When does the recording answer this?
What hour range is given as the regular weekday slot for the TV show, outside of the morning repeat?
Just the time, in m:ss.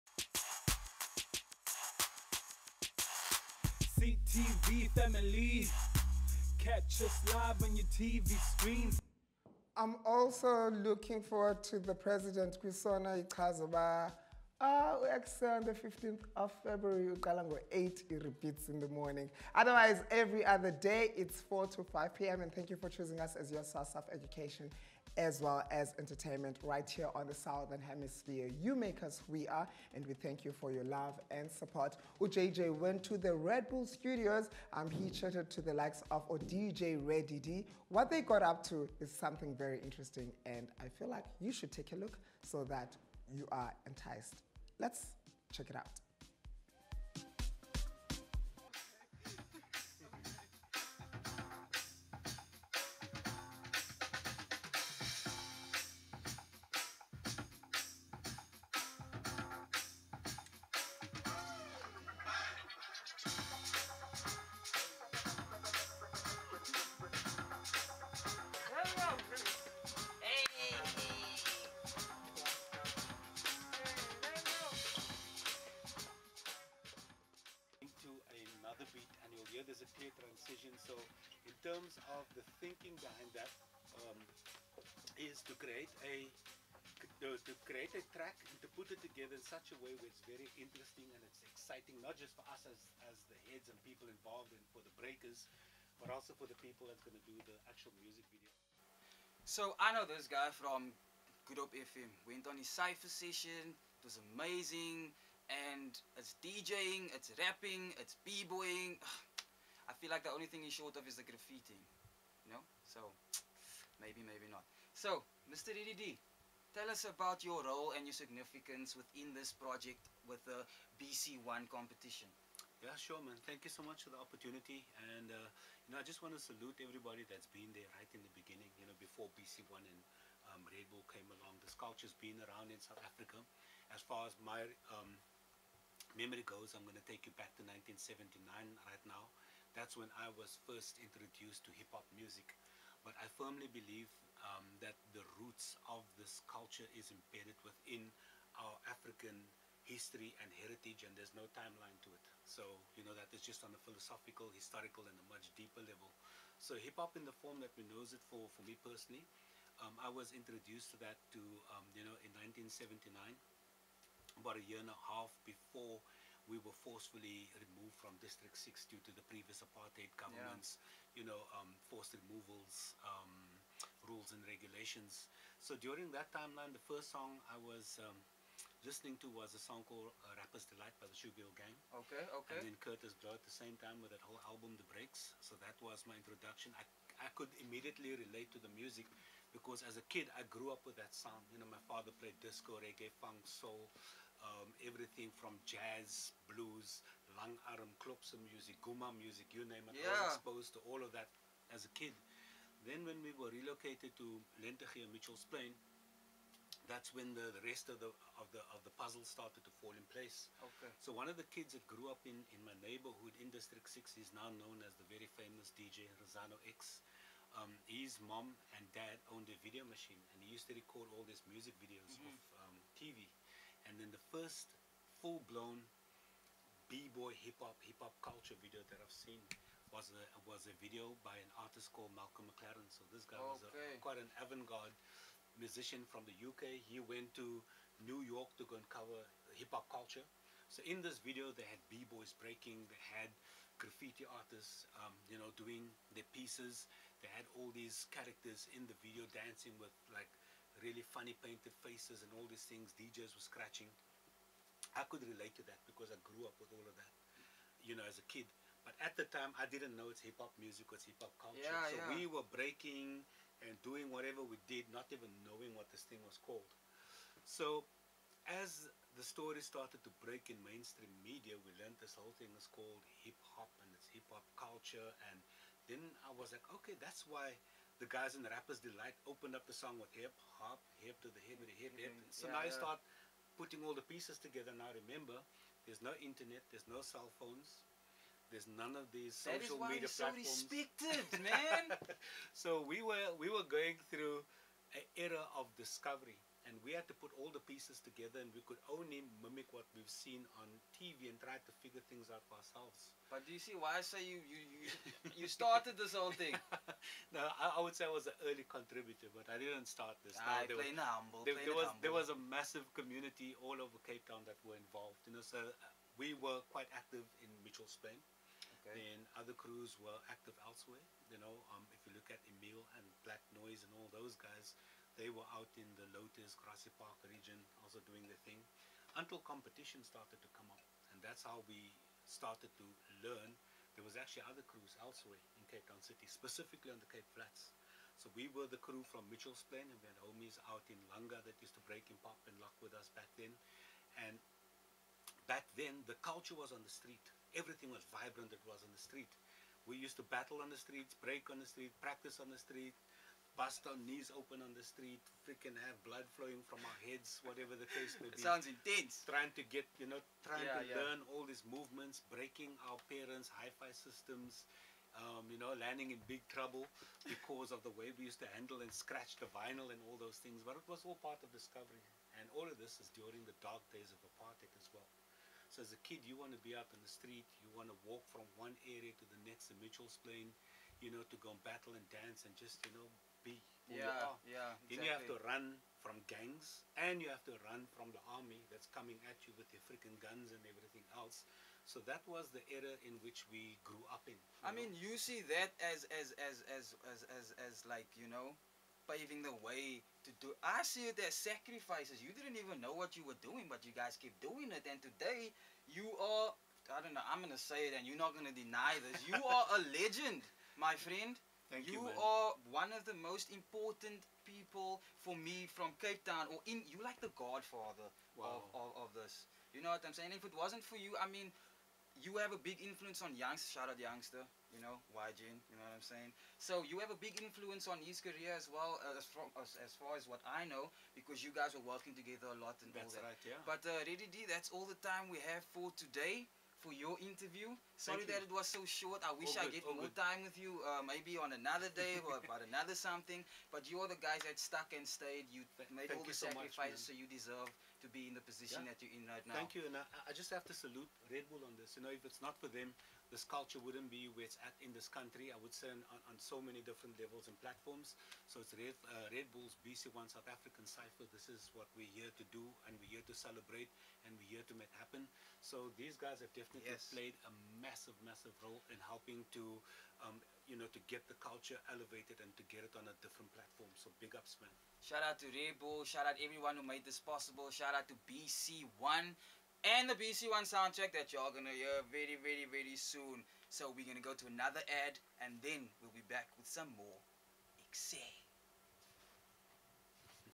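0:21.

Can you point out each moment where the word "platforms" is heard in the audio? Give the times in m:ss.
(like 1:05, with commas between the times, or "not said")
4:50, 7:37, 7:53.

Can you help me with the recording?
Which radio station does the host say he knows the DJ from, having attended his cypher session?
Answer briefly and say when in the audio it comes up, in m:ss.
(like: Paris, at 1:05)
Good Hope FM, at 1:41.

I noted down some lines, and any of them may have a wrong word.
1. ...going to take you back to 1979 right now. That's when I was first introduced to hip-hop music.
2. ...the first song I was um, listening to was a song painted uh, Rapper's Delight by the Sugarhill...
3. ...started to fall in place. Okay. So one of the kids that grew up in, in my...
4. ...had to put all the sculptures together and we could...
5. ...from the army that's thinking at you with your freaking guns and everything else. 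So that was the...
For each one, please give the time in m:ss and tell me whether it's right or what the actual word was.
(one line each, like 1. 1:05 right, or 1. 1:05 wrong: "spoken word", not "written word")
1. 2:16 right
2. 2:56 wrong: "called", not "painted"
3. 3:29 right
4. 4:56 wrong: "pieces", not "sculptures"
5. 6:27 wrong: "coming", not "thinking".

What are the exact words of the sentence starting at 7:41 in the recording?
This is what we're here to do and we're here to celebrate and we're here to make happen.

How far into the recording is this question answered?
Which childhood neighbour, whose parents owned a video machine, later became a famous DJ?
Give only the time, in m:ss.
3:35.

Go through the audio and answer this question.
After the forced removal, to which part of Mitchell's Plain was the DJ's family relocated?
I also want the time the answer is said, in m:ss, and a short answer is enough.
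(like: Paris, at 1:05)
Lentegeur, at 3:24.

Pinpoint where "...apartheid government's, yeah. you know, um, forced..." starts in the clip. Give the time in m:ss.
2:49.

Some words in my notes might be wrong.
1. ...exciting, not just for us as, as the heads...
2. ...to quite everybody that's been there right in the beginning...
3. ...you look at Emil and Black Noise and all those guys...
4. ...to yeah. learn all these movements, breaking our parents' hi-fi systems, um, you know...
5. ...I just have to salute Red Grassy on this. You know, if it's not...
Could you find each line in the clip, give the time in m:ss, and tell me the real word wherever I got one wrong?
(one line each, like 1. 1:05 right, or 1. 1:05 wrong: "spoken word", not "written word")
1. 1:31 right
2. 2:06 wrong: "salute", not "quite"
3. 5:22 right
4. 6:00 right
5. 7:30 wrong: "Bull", not "Grassy".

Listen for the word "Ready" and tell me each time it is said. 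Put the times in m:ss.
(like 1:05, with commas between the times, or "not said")
0:37, 7:14.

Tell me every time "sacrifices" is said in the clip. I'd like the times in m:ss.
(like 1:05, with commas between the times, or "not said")
6:41, 7:26.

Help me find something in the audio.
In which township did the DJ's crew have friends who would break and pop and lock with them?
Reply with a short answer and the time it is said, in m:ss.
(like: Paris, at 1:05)
Langa, at 5:41.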